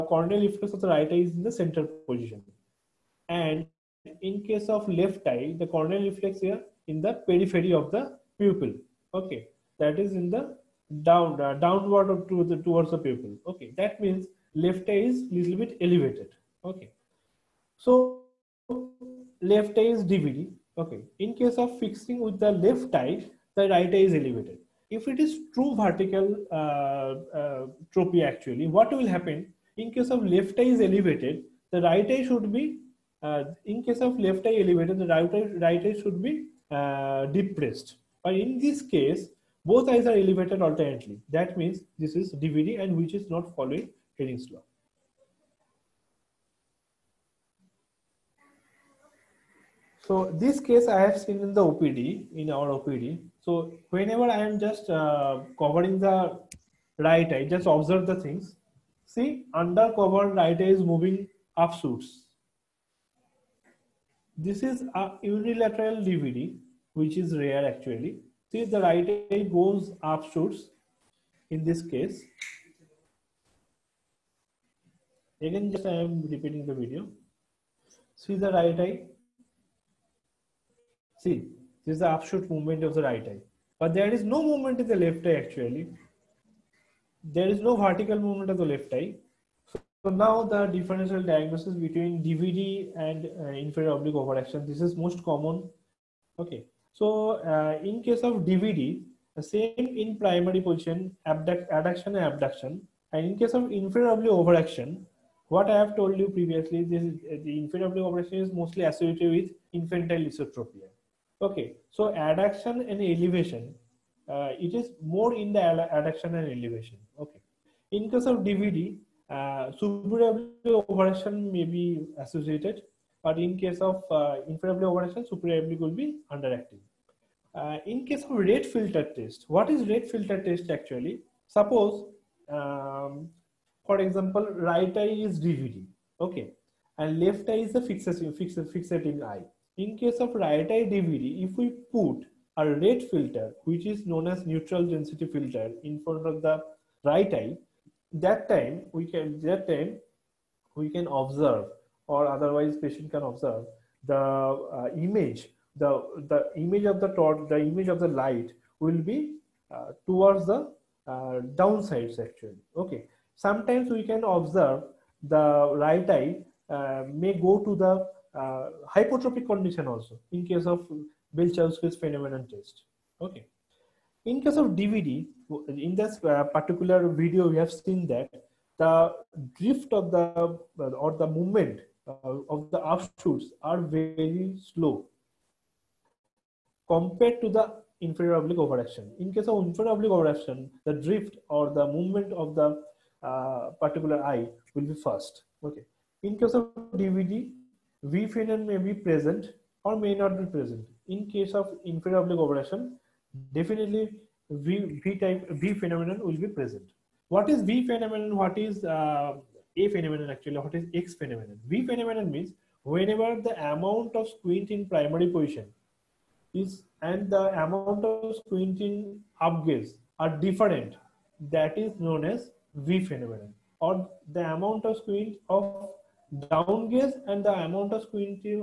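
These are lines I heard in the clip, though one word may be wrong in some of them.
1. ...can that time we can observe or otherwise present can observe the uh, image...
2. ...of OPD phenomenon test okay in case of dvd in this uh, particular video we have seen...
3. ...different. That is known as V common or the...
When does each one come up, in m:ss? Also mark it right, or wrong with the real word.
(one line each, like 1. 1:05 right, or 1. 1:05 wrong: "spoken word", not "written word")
1. 2:29 wrong: "patient", not "present"
2. 2:50 wrong: "Bell", not "OPD"
3. 3:40 wrong: "phenomenon", not "common".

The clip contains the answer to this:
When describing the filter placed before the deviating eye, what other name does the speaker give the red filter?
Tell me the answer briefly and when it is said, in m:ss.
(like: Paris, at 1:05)
neutral density filter, at 2:24.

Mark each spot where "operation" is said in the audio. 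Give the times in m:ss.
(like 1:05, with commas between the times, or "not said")
1:59, 2:04.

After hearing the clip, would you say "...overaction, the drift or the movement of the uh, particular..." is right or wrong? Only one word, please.
right.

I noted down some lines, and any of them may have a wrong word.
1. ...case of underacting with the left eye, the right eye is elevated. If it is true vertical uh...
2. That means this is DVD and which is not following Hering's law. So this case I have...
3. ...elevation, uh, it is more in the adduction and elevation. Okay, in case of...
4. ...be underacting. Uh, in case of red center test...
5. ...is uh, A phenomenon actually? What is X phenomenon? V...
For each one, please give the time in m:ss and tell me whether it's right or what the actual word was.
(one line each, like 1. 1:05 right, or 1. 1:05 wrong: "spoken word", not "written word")
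1. 0:21 wrong: "fixing", not "underacting"
2. 0:41 right
3. 1:53 right
4. 2:05 wrong: "filter", not "center"
5. 3:28 right.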